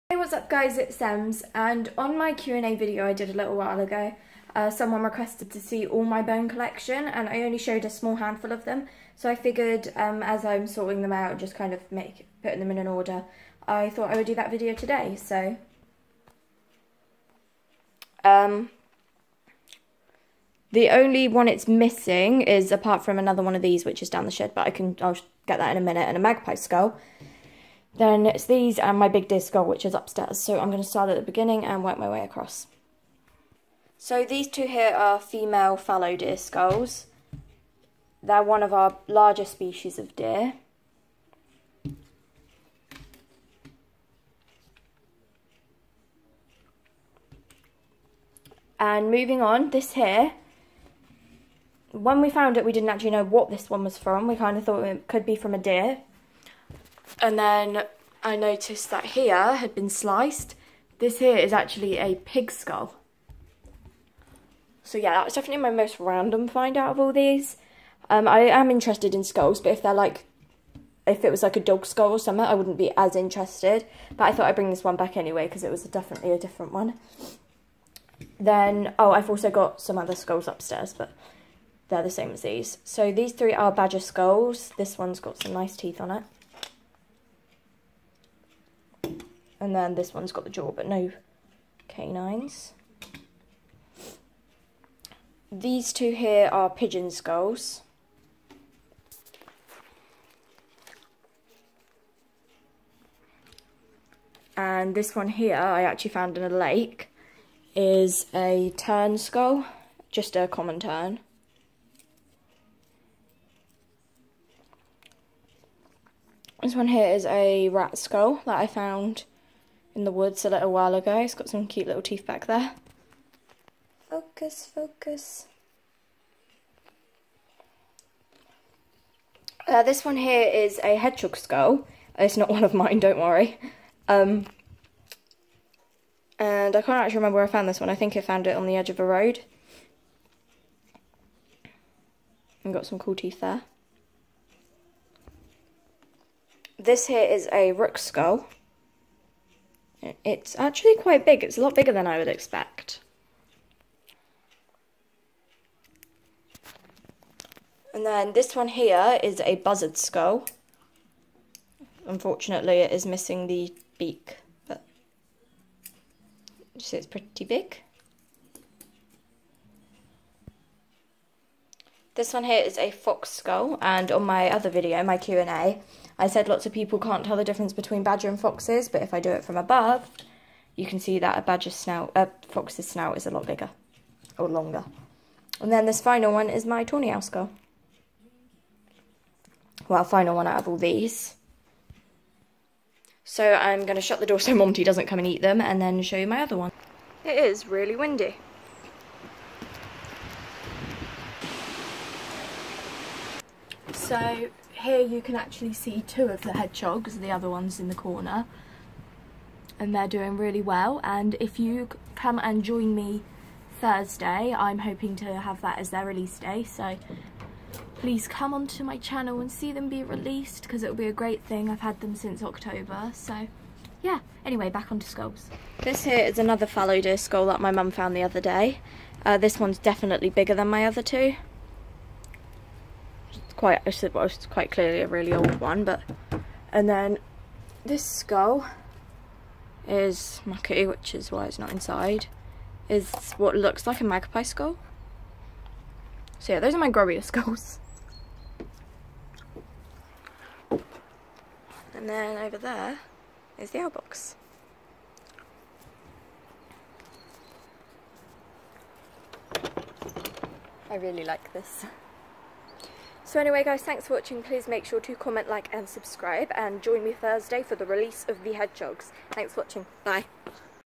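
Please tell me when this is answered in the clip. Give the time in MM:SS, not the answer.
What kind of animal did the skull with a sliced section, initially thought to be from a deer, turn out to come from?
01:02.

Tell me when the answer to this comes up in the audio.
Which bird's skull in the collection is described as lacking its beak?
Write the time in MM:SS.
02:39.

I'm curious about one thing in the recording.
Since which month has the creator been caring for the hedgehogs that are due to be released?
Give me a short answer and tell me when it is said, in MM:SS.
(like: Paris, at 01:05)
October, at 03:42.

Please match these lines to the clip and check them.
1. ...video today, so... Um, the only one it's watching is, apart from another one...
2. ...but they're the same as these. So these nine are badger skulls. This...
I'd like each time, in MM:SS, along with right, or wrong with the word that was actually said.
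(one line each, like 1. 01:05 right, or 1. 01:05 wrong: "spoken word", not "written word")
1. 00:14 wrong: "missing", not "watching"
2. 01:20 wrong: "three", not "nine".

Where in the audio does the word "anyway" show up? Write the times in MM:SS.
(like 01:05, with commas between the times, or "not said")
01:15, 03:44, 04:23.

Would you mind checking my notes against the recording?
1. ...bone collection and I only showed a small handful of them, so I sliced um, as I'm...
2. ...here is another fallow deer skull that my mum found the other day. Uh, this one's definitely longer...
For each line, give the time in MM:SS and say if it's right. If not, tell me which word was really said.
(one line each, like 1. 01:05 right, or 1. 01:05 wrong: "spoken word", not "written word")
1. 00:06 wrong: "figured", not "sliced"
2. 03:46 wrong: "bigger", not "longer".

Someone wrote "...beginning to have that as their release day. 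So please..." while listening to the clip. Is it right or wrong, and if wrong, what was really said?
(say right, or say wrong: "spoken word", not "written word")
wrong: "hoping", not "beginning".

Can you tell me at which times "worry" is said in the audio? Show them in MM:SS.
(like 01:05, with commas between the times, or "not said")
02:13.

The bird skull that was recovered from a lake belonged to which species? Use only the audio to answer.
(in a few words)
Common tern.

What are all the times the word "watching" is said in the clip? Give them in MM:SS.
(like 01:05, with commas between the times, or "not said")
04:24, 04:29.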